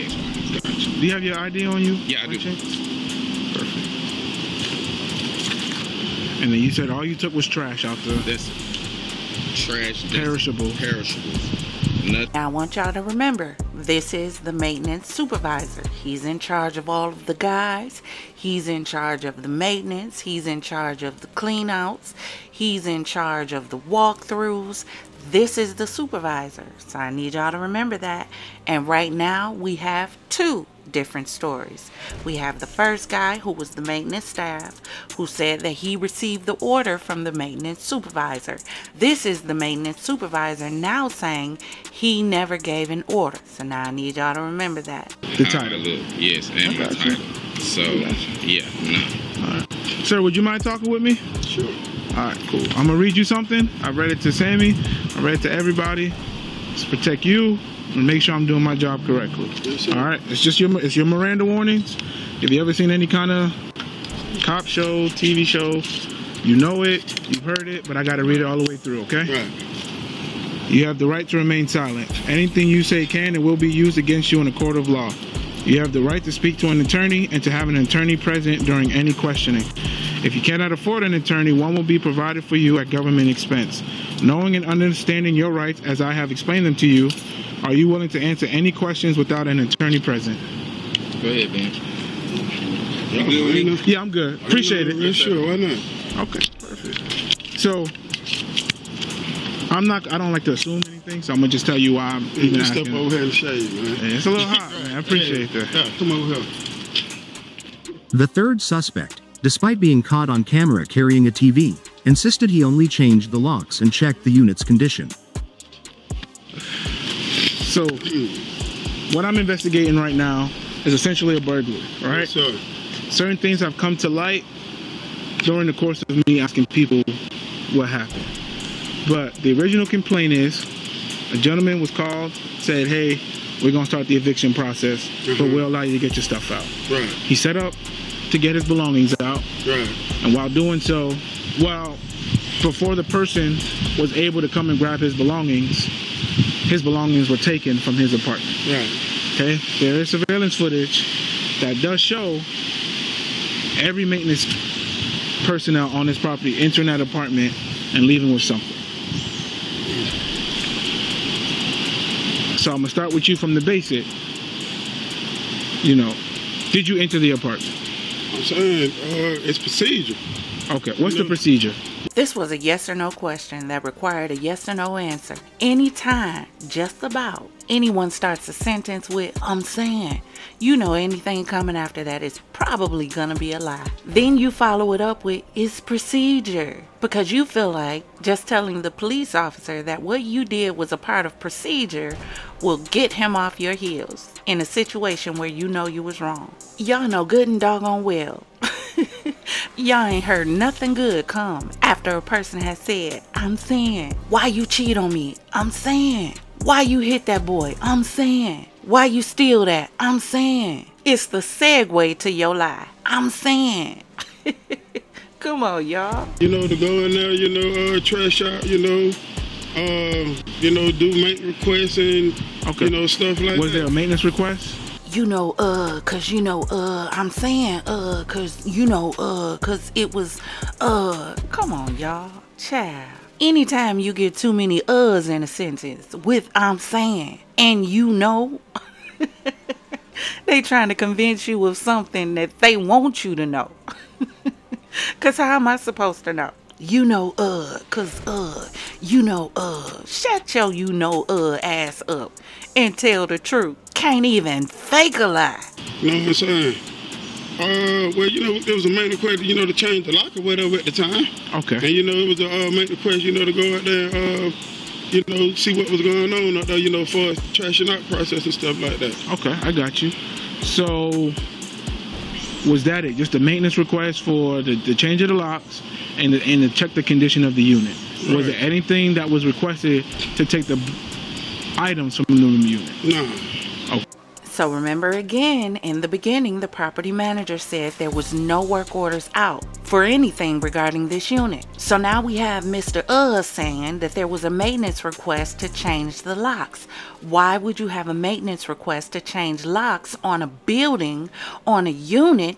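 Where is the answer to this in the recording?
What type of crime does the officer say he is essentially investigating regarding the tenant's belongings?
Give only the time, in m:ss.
2:01.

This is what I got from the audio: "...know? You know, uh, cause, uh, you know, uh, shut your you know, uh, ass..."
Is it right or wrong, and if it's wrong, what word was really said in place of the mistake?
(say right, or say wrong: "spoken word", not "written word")
right.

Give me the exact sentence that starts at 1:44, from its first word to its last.
Yeah, it's a little hot, man.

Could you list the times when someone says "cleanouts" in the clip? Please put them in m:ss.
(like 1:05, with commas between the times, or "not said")
0:21.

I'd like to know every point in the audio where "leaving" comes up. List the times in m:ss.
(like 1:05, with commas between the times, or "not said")
2:38.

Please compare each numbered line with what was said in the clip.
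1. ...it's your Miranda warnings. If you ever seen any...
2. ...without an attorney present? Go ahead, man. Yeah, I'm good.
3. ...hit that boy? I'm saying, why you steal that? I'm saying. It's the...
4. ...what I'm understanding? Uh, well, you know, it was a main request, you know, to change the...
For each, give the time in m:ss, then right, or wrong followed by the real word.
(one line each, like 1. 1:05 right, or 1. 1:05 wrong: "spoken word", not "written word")
1. 1:00 right
2. 1:29 right
3. 3:27 right
4. 4:16 wrong: "saying", not "understanding".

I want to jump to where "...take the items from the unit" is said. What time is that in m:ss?
4:40.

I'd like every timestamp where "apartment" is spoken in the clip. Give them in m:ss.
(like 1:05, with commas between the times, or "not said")
2:28, 2:37, 2:47.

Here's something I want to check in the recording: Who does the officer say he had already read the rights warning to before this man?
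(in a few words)
Sammy.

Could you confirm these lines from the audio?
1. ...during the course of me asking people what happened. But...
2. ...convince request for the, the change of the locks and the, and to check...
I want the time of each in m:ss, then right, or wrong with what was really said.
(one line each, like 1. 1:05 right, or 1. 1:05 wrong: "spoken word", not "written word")
1. 2:05 right
2. 4:33 wrong: "maintenance", not "convince".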